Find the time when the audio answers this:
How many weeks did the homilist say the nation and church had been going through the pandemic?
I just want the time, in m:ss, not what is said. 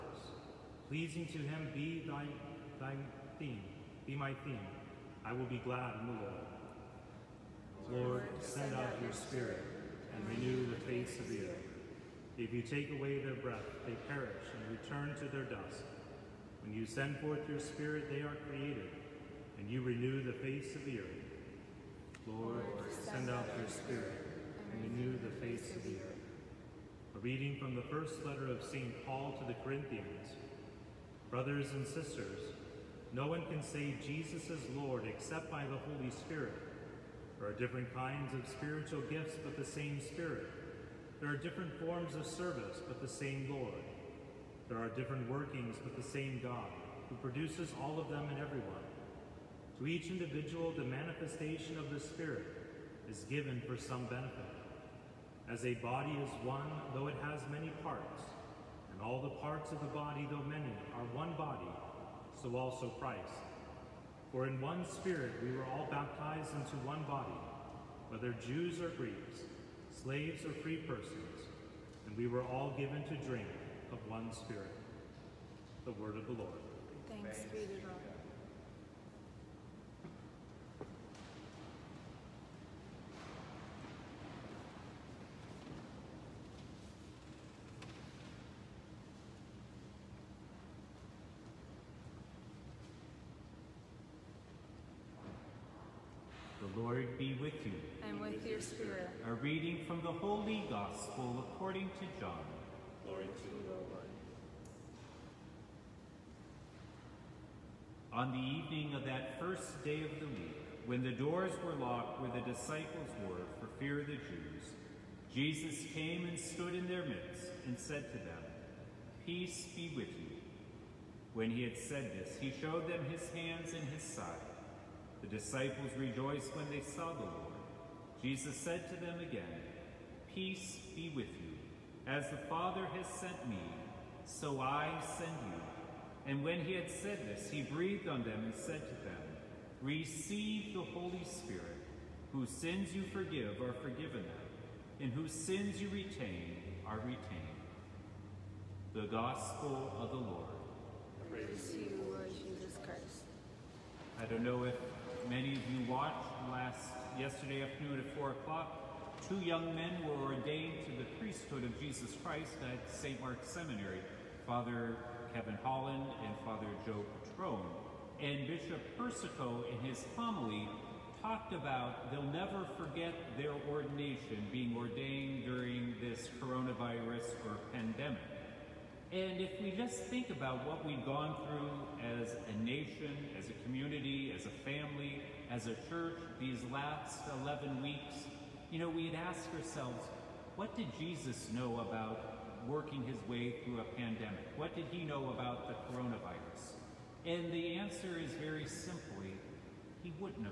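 3:07.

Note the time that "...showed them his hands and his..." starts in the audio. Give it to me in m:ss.
2:02.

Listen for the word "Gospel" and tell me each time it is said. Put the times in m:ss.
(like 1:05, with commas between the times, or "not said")
1:40, 2:29.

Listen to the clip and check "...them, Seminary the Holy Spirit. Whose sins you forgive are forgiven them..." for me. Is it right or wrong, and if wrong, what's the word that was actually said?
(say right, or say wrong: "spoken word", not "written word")
wrong: "Receive", not "Seminary".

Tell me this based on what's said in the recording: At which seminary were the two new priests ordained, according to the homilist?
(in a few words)
St. Mark's Seminary.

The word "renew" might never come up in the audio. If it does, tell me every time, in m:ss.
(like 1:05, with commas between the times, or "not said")
0:10, 0:19, 0:24.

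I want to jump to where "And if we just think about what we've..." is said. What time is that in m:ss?
2:59.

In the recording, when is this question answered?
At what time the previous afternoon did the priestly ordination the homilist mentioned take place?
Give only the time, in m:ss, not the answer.
2:38.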